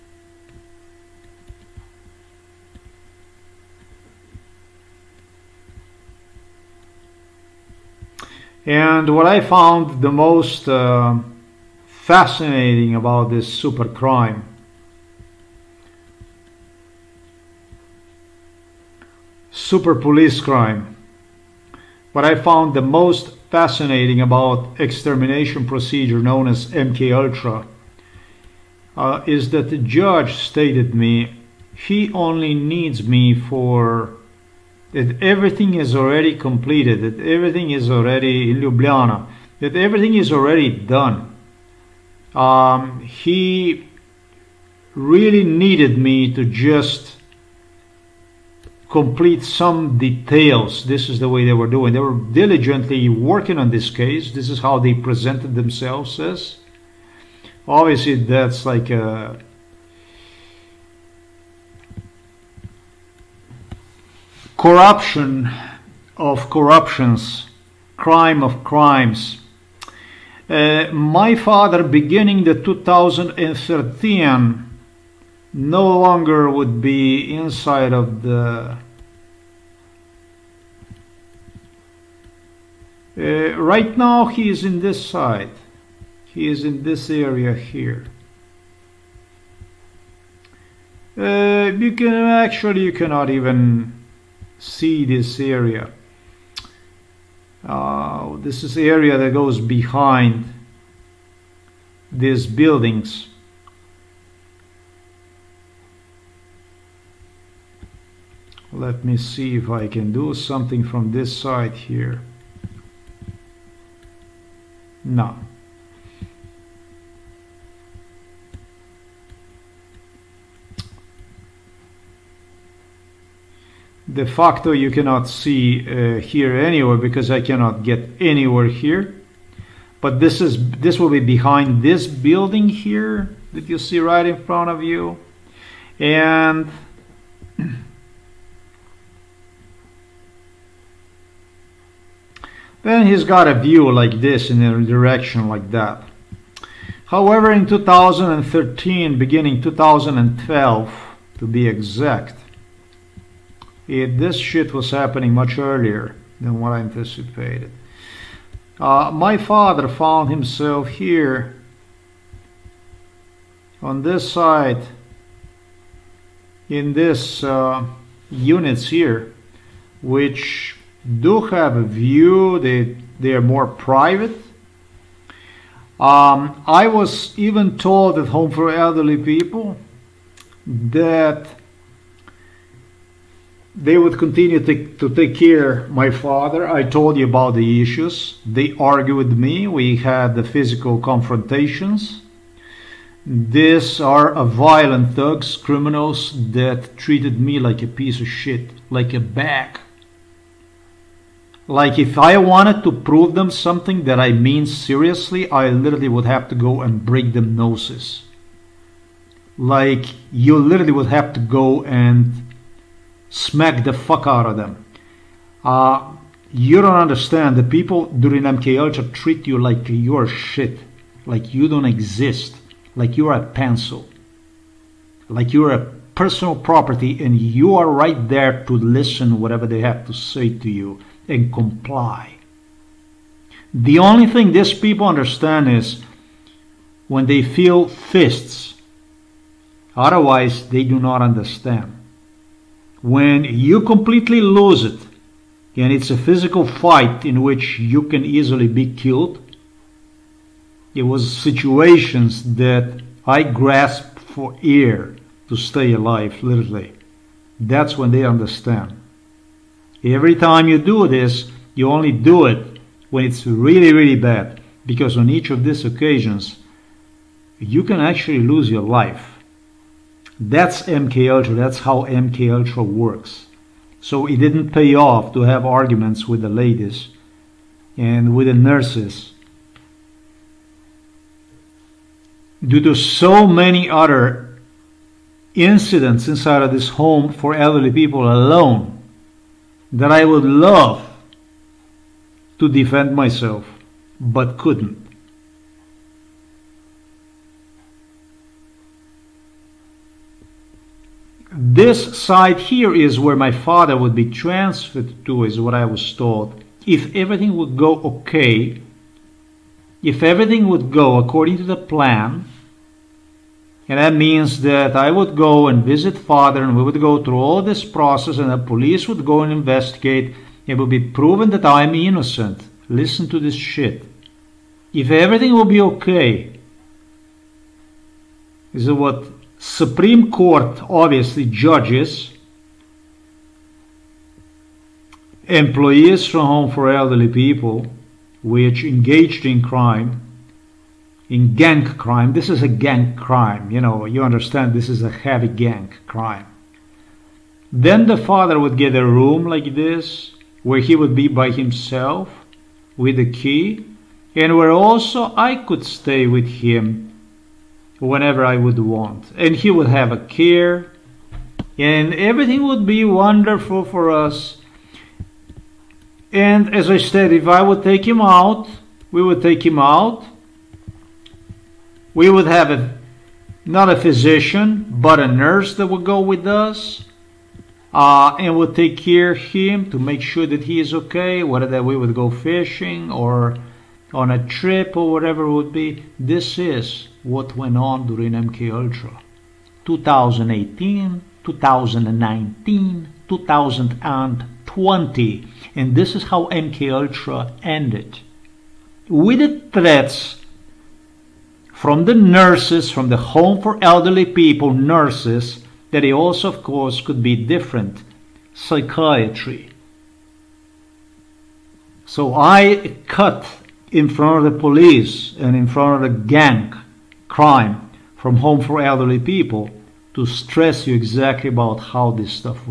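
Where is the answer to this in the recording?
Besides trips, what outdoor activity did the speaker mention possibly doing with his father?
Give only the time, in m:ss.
6:22.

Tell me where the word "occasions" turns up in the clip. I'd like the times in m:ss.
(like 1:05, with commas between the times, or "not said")
4:25.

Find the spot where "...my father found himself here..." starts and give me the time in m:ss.
2:39.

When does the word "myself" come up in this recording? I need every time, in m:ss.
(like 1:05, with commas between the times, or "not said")
4:53.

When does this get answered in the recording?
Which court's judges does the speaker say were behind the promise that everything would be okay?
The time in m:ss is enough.
5:29.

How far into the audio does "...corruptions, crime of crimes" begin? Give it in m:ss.
1:06.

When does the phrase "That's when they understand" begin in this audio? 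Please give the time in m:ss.
4:17.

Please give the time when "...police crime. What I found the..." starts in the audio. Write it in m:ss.
0:19.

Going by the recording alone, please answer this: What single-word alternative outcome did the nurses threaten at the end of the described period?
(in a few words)
Psychiatry.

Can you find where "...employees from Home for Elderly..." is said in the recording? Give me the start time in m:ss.
5:35.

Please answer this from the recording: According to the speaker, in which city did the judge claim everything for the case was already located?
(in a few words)
Ljubljana.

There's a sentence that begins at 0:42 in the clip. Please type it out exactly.
Um, he really needed me to just complete some details.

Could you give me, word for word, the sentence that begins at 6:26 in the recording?
This is what went on during MK Ultra.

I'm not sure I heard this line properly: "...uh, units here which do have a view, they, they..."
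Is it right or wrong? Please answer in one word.
right.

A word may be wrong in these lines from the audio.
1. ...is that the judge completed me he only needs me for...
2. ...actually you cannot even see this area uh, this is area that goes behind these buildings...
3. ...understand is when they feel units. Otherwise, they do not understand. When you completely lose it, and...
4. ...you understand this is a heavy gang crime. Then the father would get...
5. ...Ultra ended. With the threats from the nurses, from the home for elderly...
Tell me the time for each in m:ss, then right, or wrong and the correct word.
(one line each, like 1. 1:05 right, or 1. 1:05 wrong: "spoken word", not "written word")
1. 0:29 wrong: "stated", not "completed"
2. 1:32 right
3. 3:55 wrong: "fists", not "units"
4. 5:44 right
5. 6:36 right.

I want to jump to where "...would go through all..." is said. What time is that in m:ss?
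5:16.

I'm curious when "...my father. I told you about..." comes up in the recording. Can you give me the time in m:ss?
3:05.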